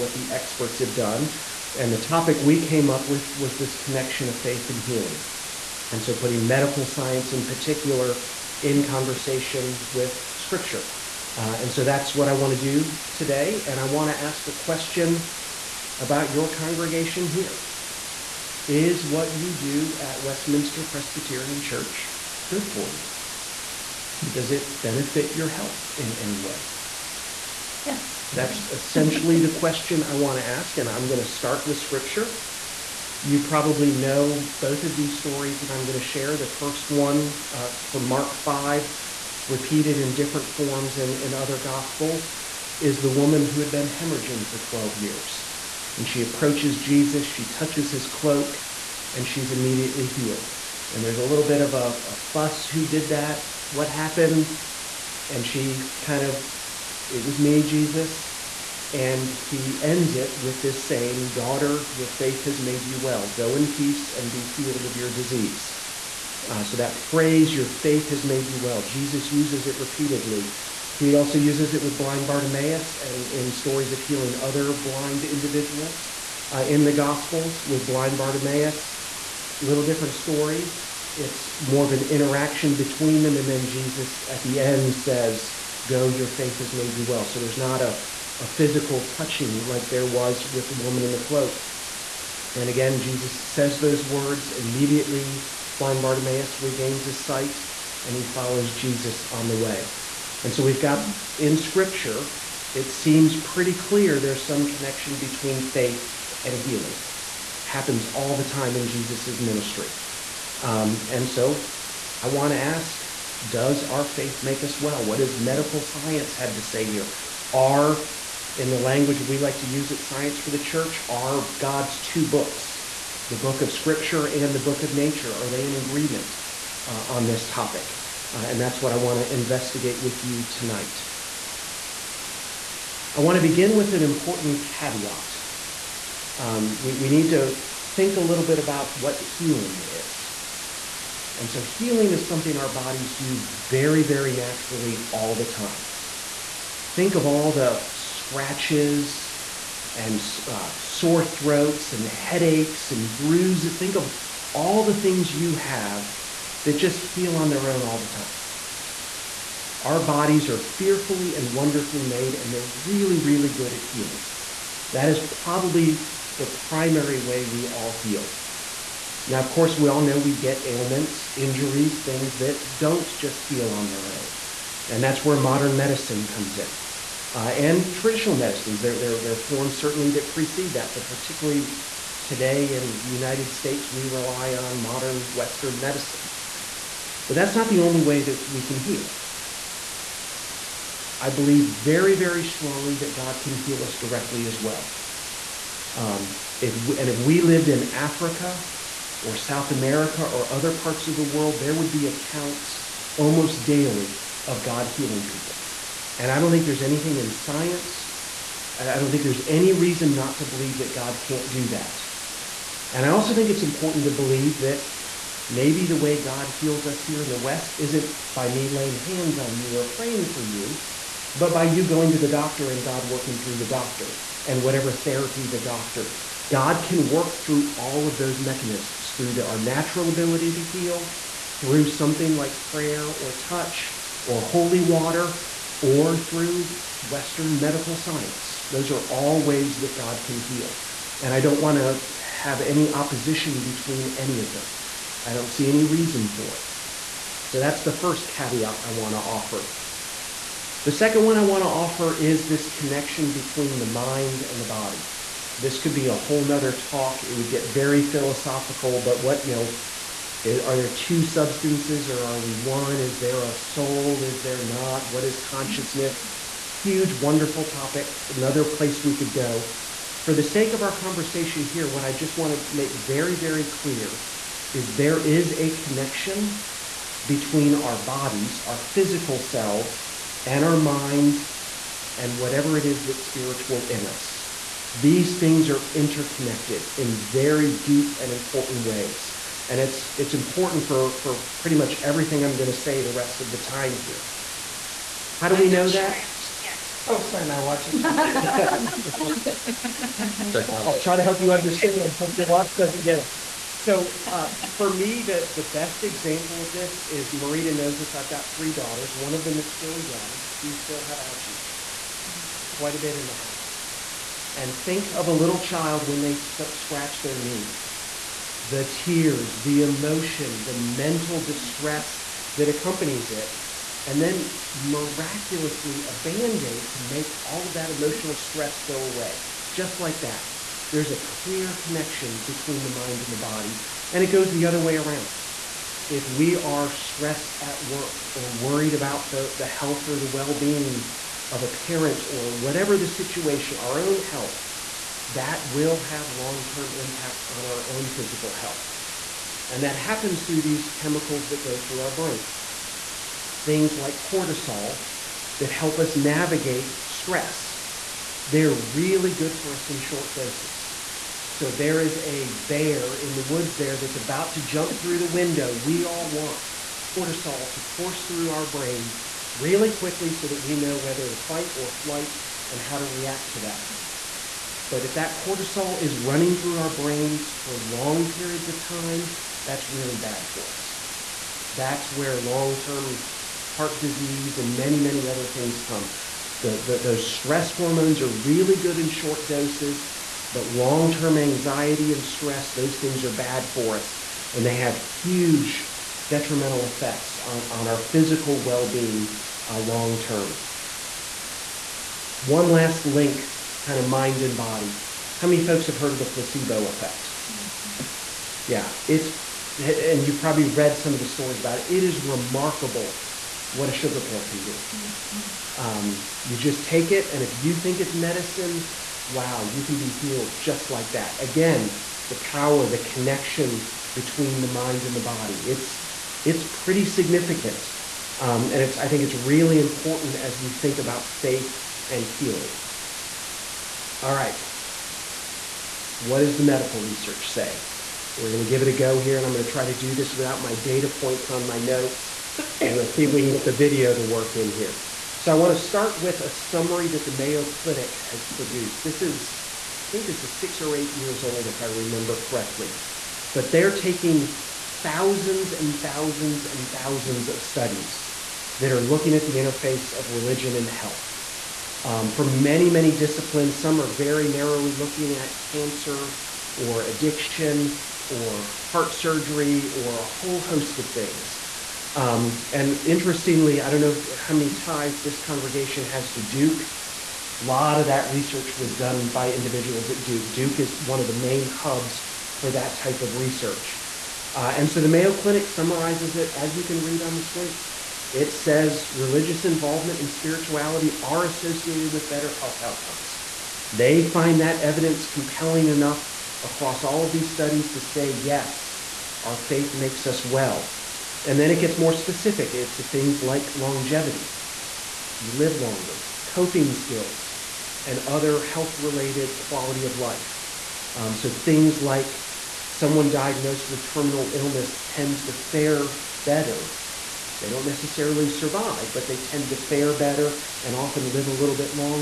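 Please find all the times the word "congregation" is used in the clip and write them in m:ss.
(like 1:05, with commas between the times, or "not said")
0:16, 7:55.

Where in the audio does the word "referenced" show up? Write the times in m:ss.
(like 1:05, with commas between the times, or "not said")
not said.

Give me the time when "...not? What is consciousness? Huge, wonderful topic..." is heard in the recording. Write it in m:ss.
4:24.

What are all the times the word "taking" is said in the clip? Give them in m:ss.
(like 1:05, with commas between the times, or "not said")
7:33.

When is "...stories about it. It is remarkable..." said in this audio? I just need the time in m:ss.
6:51.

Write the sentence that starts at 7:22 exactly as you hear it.
And let's see if we can get the video to work in here.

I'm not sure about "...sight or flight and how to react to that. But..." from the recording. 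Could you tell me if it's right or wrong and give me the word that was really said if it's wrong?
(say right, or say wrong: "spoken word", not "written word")
wrong: "fight", not "sight".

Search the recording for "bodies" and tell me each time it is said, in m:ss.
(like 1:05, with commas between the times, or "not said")
2:22, 2:40, 4:38.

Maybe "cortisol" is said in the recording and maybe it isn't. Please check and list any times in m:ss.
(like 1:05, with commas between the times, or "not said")
5:54, 6:07, 6:15.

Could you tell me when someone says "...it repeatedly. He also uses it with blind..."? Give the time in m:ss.
1:09.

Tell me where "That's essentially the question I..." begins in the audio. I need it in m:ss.
0:28.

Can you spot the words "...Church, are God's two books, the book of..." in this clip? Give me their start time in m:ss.
2:00.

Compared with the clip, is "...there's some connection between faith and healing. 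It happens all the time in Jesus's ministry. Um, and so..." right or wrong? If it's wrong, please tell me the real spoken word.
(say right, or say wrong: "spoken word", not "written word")
right.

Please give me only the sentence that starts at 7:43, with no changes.
Some are very narrowly looking at cancer or addiction or heart surgery or a whole host of things.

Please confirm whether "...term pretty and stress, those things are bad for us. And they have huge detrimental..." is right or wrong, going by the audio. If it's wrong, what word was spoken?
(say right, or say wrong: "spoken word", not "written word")
wrong: "anxiety", not "pretty".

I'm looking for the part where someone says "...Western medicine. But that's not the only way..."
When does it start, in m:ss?
3:05.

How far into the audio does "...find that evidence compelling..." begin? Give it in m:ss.
8:14.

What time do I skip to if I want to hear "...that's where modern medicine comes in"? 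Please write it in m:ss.
2:55.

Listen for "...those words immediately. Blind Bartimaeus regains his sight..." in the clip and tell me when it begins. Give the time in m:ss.
1:33.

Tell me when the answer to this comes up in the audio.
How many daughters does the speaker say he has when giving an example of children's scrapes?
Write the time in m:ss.
5:08.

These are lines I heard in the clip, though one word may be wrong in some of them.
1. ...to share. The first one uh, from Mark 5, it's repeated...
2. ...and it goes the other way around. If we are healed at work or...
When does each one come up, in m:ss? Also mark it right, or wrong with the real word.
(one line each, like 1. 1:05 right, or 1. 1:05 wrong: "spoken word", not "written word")
1. 0:35 right
2. 5:34 wrong: "stressed", not "healed".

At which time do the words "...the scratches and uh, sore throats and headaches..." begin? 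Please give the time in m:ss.
2:27.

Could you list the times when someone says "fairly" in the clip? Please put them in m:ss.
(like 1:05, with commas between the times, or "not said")
not said.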